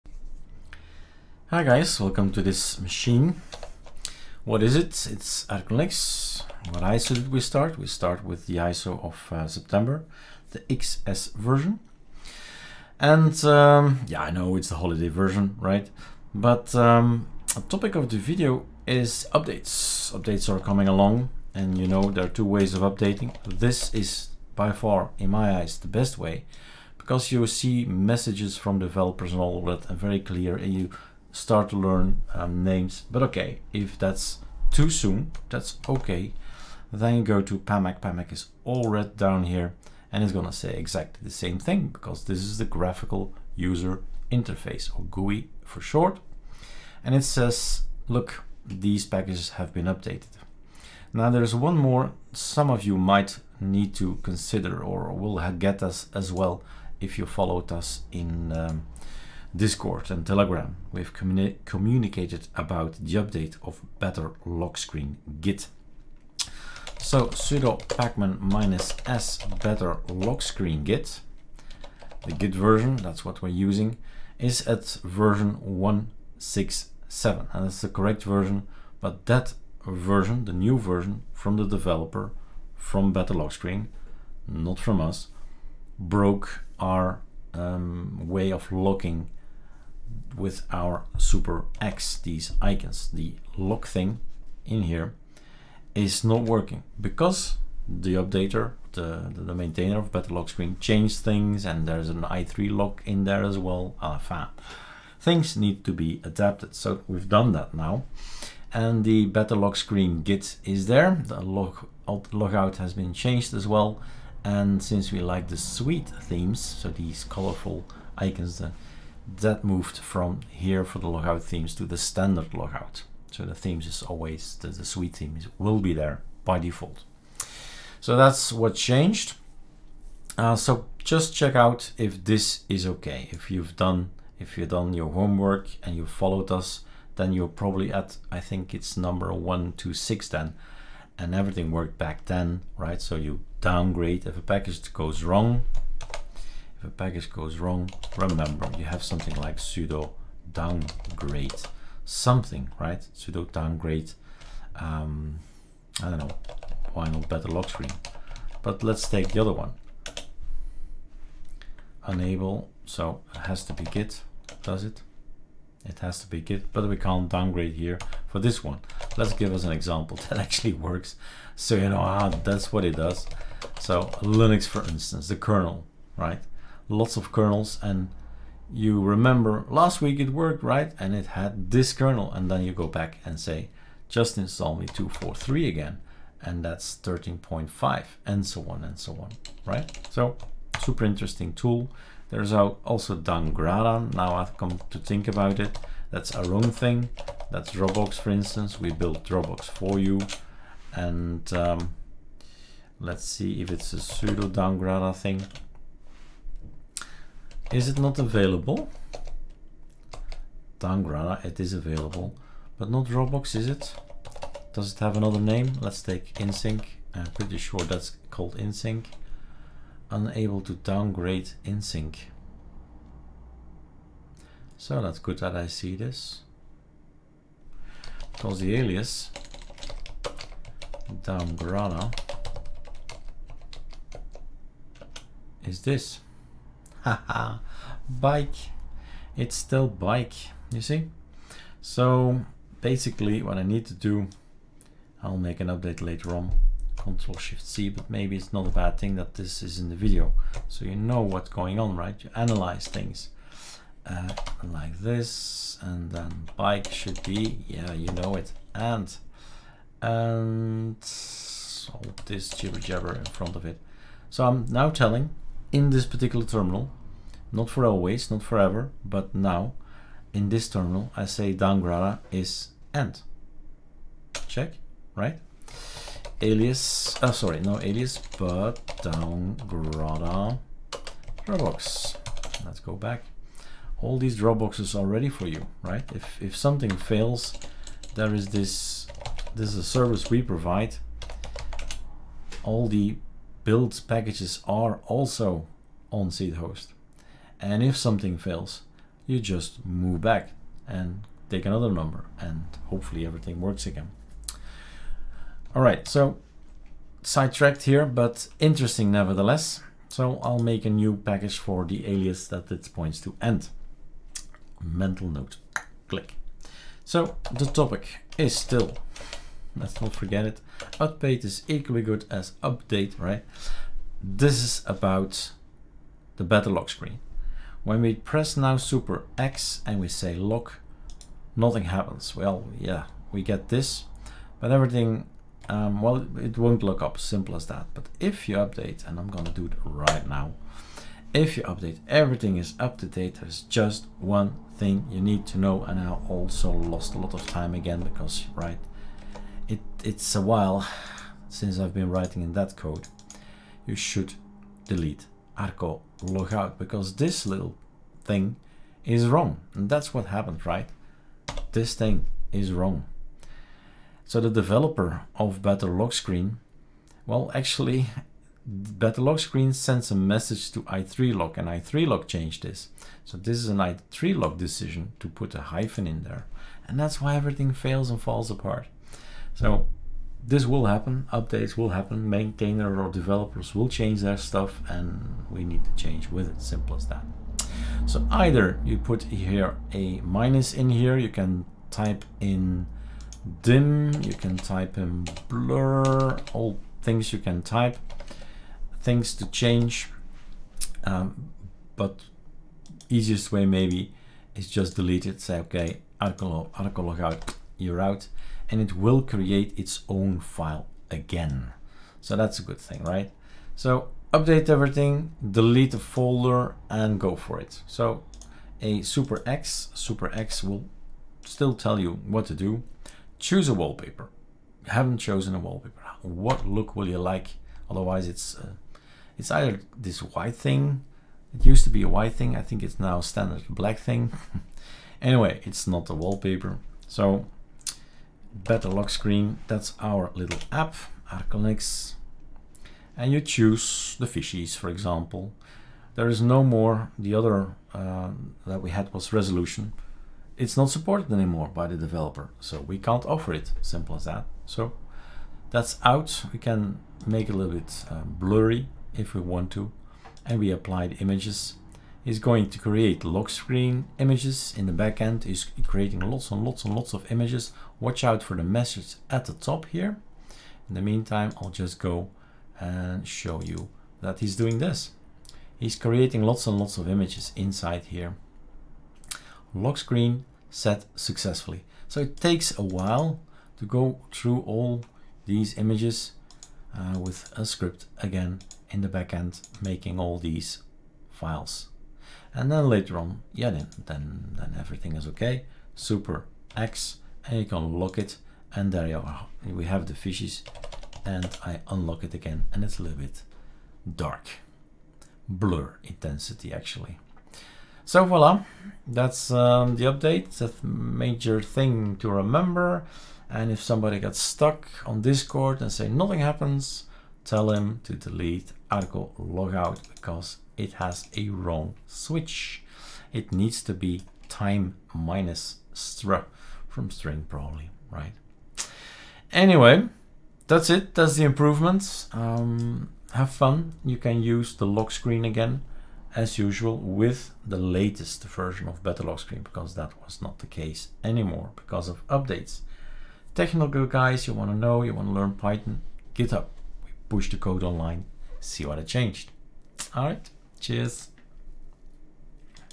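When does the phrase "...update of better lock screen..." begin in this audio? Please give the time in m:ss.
1:03.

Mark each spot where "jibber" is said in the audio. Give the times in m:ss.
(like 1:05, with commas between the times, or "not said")
4:22.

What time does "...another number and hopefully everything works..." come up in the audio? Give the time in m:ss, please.
5:01.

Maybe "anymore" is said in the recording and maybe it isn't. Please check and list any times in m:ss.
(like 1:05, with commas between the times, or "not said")
7:31, 9:01.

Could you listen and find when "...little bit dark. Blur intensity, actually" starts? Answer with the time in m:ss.
8:23.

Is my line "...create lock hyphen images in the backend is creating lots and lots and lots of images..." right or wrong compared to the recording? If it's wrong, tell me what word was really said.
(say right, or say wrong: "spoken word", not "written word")
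wrong: "screen", not "hyphen".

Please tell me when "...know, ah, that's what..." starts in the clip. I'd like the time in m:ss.
2:51.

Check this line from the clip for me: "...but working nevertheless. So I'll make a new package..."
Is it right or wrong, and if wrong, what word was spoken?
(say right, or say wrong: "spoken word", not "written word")
wrong: "interesting", not "working".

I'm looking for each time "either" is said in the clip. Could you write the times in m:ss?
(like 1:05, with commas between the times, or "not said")
6:28, 7:09.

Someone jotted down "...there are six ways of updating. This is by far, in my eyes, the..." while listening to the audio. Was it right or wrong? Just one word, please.
wrong.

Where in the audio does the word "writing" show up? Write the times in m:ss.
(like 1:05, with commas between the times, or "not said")
5:52.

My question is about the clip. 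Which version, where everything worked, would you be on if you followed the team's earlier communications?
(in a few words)
126.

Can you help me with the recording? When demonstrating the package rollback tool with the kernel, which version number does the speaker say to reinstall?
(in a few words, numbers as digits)
243.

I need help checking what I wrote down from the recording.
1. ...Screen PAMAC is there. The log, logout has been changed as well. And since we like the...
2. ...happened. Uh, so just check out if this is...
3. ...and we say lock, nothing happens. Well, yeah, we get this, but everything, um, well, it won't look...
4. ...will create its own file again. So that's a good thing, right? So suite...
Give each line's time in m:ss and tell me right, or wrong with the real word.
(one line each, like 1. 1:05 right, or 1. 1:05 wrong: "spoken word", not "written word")
1. 1:49 wrong: "Git", not "PAMAC"
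2. 2:08 wrong: "changed", not "happened"
3. 5:29 right
4. 6:48 wrong: "update", not "suite".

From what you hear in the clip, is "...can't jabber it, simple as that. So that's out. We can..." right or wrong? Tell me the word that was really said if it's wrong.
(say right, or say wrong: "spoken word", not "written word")
wrong: "offer", not "jabber".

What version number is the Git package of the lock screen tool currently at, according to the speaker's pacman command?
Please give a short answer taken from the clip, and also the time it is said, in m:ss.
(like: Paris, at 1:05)
167, at 1:15.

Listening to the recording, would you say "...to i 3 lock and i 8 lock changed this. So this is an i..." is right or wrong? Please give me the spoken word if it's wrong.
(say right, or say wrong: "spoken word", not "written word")
wrong: "3", not "8".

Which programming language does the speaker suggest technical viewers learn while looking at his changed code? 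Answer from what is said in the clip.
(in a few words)
Python.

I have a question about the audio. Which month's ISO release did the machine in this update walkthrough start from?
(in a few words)
September.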